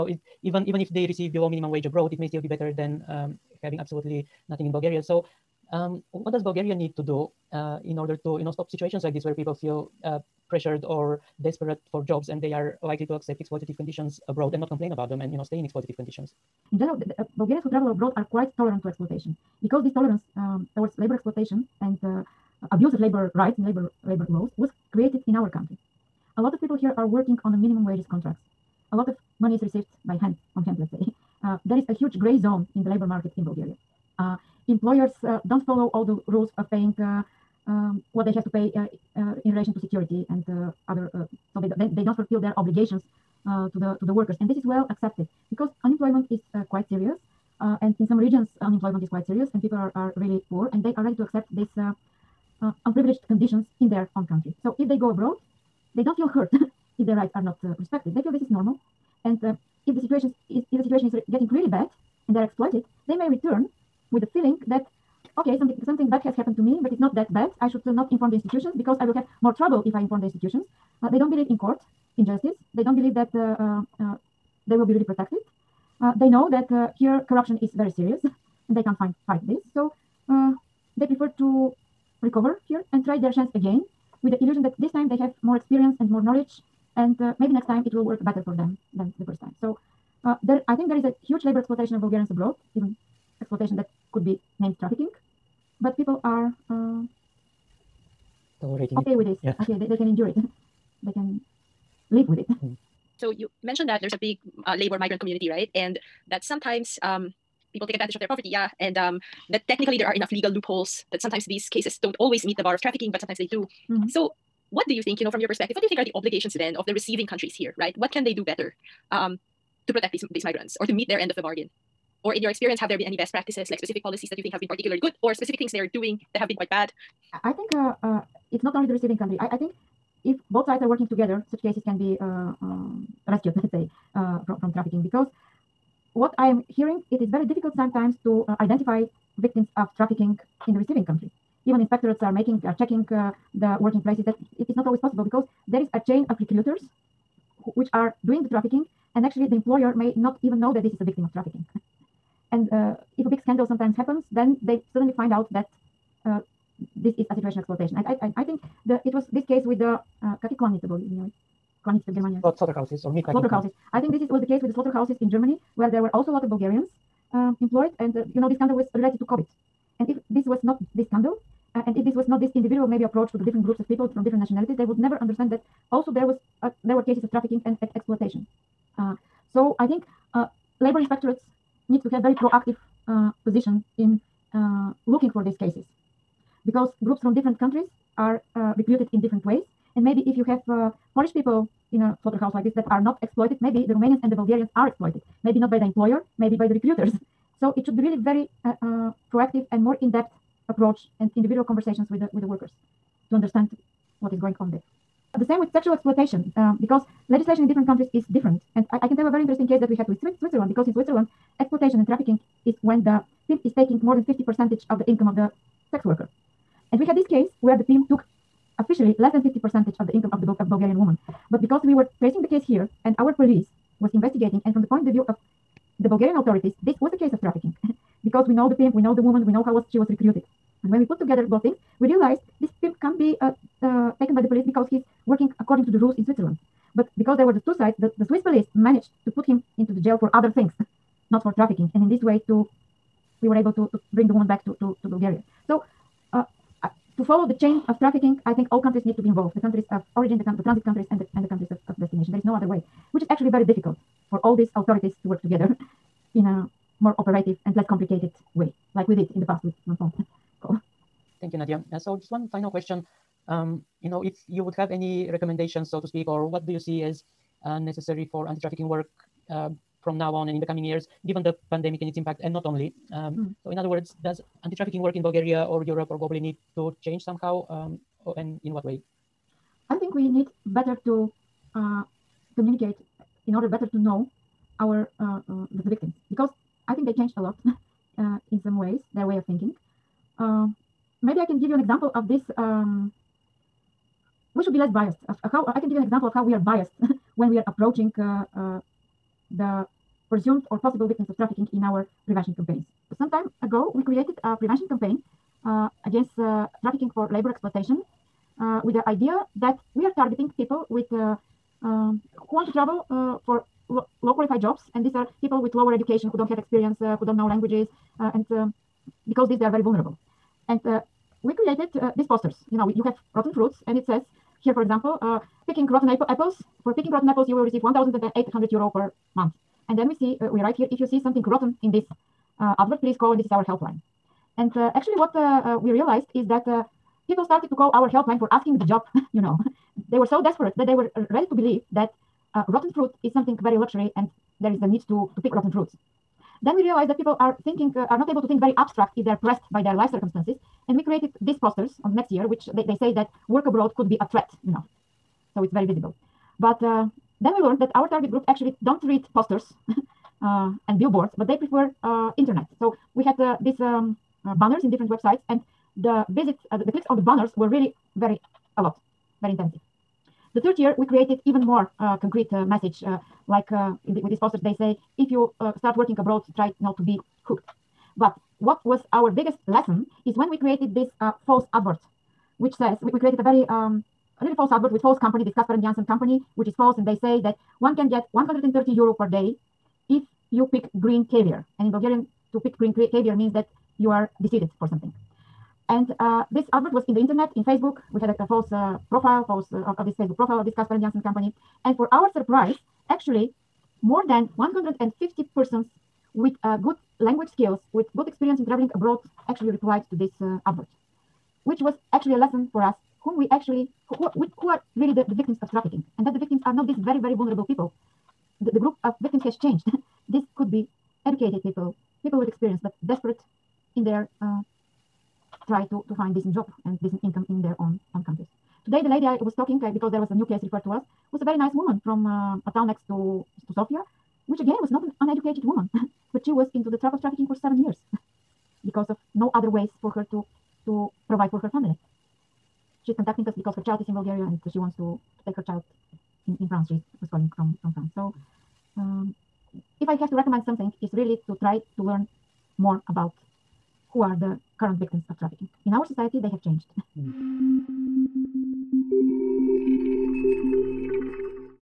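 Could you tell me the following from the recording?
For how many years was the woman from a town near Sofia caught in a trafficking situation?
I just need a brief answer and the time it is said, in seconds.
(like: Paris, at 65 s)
7 years, at 437 s.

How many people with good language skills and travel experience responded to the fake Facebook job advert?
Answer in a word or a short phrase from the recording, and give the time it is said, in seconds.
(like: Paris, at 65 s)
more than 150, at 404 s.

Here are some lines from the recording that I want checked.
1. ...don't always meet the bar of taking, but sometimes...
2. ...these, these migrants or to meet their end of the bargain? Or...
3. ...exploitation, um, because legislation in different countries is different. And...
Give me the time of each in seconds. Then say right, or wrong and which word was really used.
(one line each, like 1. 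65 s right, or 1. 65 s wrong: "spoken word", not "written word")
1. 112 s wrong: "trafficking", not "taking"
2. 120 s right
3. 205 s right.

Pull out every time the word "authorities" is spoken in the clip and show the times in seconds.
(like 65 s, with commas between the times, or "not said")
226 s, 254 s.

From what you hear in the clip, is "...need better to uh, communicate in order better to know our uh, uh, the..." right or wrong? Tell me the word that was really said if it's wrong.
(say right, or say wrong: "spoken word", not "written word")
right.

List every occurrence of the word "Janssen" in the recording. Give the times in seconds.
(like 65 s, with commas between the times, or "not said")
385 s, 401 s.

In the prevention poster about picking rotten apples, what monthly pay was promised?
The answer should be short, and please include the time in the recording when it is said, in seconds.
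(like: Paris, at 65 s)
1800 euro, at 327 s.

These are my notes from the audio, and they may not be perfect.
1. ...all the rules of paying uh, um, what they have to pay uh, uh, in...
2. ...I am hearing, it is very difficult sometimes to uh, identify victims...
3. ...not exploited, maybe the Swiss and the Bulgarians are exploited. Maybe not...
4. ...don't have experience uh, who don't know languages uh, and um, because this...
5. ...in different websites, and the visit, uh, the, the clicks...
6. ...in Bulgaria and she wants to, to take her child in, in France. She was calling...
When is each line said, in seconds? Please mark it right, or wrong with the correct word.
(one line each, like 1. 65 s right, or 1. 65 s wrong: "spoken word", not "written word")
1. 35 s right
2. 136 s right
3. 192 s wrong: "Romanians", not "Swiss"
4. 316 s right
5. 364 s right
6. 444 s right.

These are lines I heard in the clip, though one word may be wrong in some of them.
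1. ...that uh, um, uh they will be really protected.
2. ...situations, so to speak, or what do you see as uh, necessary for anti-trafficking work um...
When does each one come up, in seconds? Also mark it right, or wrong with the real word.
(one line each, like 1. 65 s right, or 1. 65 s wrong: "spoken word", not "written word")
1. 73 s right
2. 265 s wrong: "recommendations", not "situations".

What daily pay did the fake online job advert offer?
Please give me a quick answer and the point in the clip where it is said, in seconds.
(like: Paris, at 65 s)
130 euro, at 388 s.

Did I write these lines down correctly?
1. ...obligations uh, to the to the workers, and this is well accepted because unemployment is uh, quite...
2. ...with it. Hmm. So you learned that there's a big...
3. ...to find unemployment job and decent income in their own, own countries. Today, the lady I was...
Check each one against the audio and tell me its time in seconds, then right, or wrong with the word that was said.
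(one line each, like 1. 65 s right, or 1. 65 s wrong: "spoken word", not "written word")
1. 42 s right
2. 102 s wrong: "mentioned", not "learned"
3. 426 s wrong: "decent", not "unemployment".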